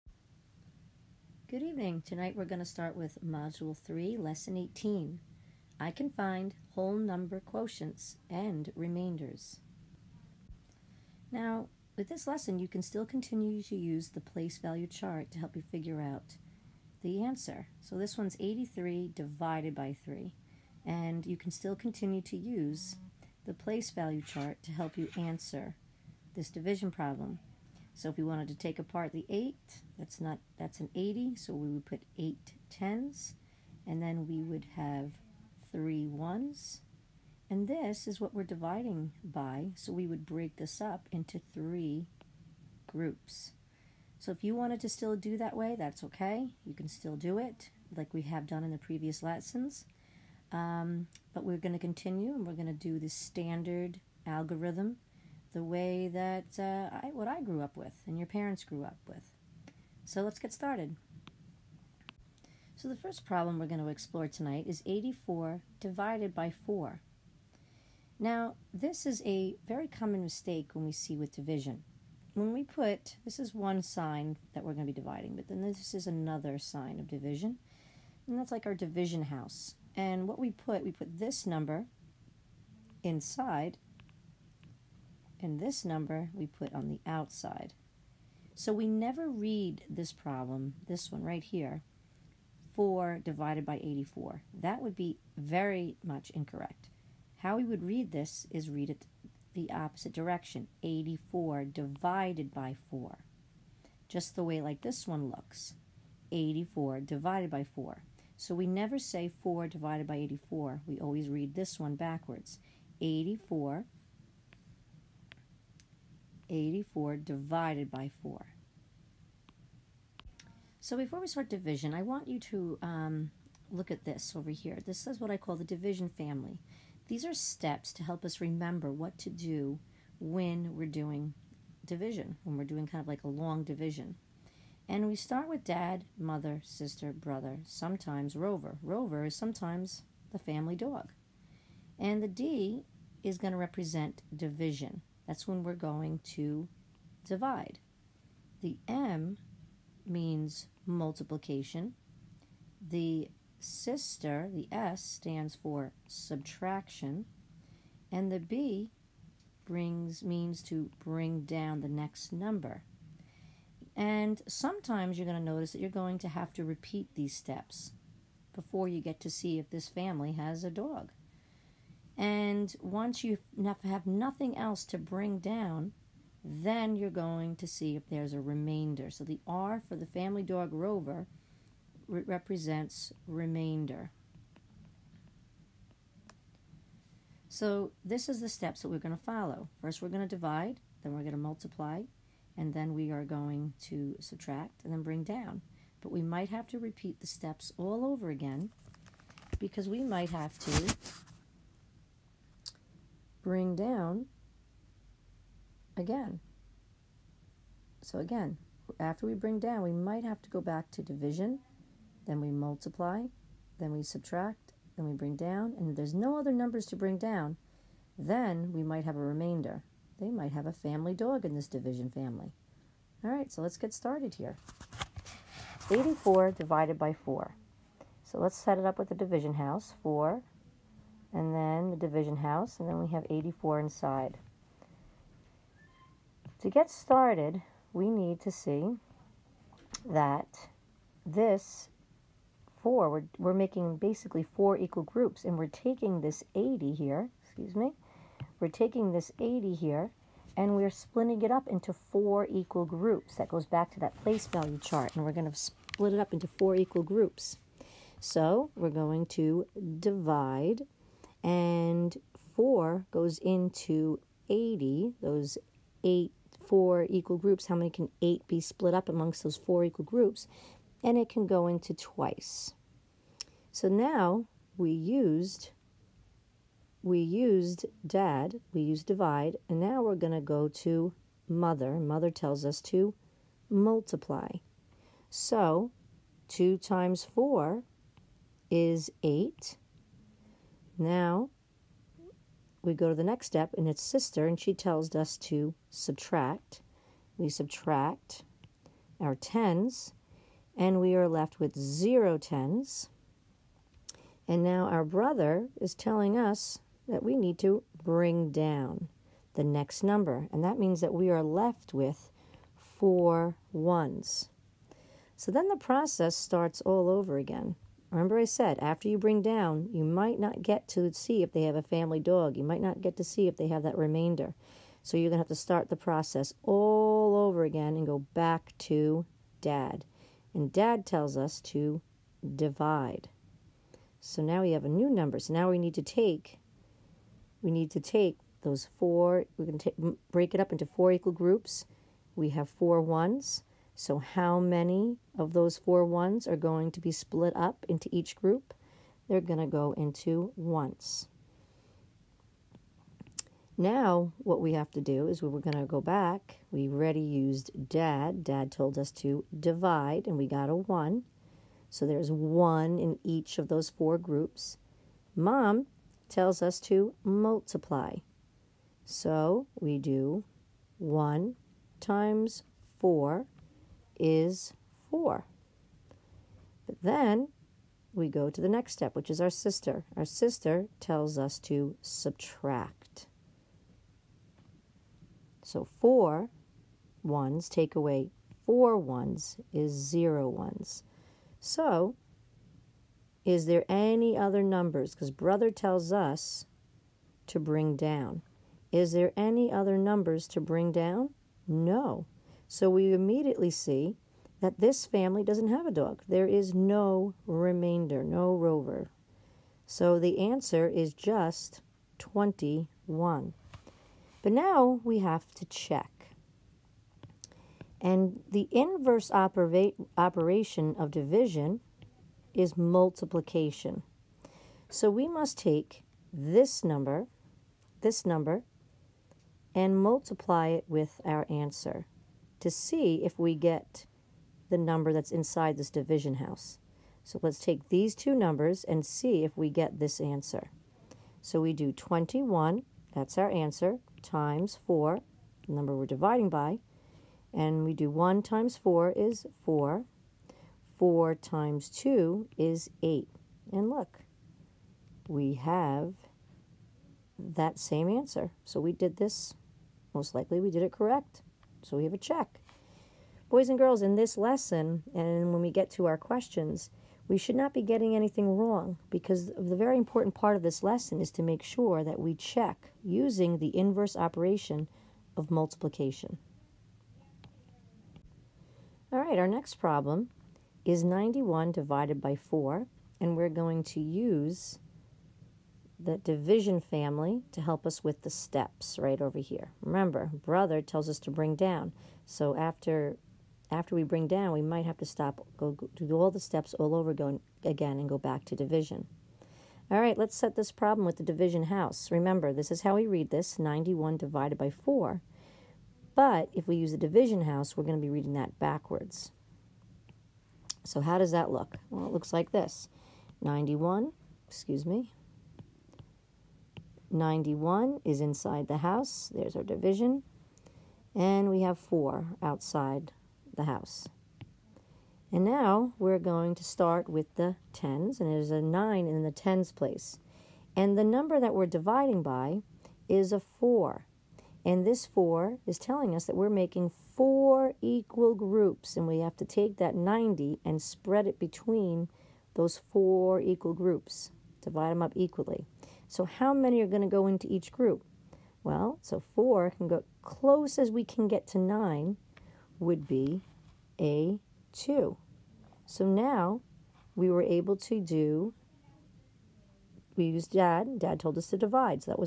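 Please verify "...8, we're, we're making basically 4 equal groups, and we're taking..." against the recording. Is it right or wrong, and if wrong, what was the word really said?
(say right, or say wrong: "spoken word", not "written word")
wrong: "4", not "8".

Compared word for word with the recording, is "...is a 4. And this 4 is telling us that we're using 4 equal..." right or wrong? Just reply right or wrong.
wrong.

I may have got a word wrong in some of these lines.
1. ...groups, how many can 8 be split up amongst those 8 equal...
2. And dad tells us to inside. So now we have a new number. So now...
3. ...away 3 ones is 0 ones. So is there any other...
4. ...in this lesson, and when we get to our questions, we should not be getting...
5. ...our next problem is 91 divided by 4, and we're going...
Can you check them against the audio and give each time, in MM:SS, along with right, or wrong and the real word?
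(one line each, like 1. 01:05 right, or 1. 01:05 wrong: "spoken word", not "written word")
1. 04:27 wrong: "4", not "8"
2. 05:30 wrong: "divide", not "inside"
3. 06:27 wrong: "4", not "3"
4. 07:44 right
5. 07:59 right.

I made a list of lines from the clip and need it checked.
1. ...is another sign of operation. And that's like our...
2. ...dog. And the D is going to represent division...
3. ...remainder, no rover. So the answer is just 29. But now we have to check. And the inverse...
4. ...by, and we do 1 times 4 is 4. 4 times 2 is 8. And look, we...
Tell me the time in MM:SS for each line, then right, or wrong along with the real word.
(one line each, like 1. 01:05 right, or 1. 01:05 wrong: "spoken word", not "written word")
1. 01:15 wrong: "division", not "operation"
2. 02:20 right
3. 06:47 wrong: "21", not "29"
4. 07:26 right.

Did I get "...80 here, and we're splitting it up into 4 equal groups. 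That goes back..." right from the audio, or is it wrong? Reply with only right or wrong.
right.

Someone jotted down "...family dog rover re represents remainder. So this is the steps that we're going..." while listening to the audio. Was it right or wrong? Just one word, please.
right.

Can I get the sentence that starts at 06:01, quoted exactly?
So there's 1 in each of those four groups.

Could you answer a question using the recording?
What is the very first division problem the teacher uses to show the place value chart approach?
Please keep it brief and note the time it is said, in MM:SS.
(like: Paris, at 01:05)
83 divided by 3, at 00:18.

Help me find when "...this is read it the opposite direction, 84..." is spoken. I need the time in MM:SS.
01:38.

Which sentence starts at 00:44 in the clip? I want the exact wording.
So if you wanted to still do that way, that's okay.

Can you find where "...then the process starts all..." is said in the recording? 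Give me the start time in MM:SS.
05:15.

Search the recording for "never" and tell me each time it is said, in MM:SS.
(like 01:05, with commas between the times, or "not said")
01:28, 01:48.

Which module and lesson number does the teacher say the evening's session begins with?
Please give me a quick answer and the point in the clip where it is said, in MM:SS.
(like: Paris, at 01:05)
Module 3, Lesson 18, at 00:03.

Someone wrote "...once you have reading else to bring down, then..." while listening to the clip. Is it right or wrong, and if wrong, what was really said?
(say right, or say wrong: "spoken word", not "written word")
wrong: "nothing", not "reading".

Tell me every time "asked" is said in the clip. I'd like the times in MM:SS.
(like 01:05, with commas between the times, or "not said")
not said.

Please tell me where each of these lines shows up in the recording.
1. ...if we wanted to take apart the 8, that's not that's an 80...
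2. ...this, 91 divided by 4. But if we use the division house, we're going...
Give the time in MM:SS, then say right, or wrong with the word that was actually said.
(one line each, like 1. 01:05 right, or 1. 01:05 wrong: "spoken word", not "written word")
1. 00:28 right
2. 08:23 right.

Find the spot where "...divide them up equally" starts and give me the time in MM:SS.
09:04.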